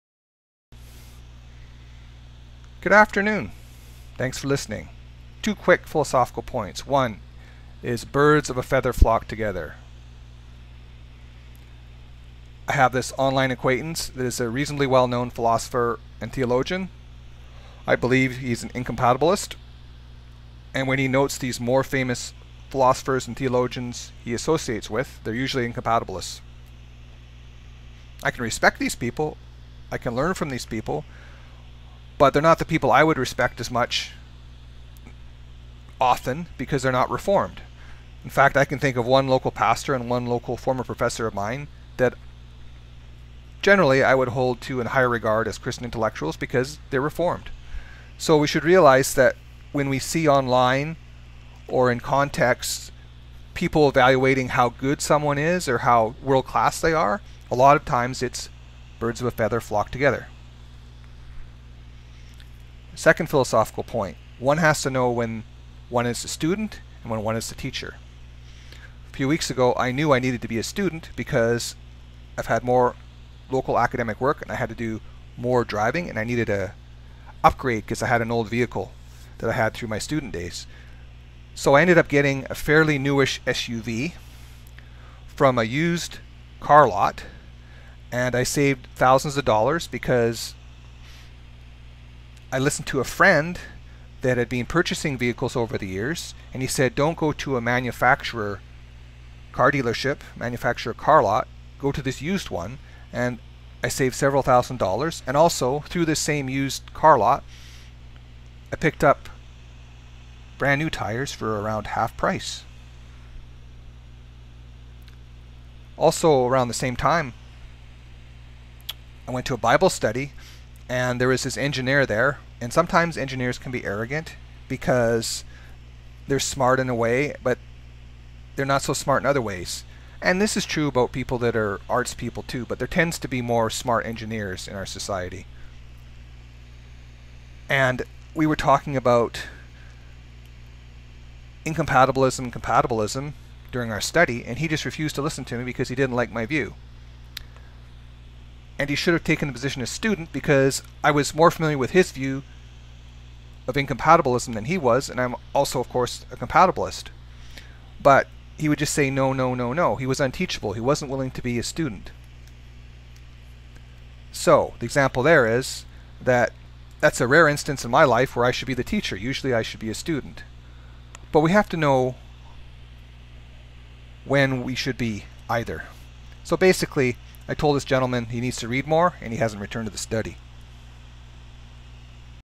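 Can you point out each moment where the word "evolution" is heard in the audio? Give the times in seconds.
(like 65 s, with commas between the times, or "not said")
not said.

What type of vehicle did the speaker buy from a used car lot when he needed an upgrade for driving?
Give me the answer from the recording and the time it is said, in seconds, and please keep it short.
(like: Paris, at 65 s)
SUV, at 83 s.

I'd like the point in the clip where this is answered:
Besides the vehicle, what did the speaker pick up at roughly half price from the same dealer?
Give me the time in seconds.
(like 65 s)
110 s.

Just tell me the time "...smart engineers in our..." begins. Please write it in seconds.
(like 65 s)
133 s.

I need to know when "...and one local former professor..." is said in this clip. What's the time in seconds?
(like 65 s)
39 s.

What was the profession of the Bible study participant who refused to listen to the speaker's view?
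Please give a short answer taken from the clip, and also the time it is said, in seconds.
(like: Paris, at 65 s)
Engineer, at 121 s.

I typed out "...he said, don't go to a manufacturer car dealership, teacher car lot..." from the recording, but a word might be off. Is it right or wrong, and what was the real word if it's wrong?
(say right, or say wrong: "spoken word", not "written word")
wrong: "manufacturer", not "teacher".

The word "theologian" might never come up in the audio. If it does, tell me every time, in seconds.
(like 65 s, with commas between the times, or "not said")
16 s, 23 s.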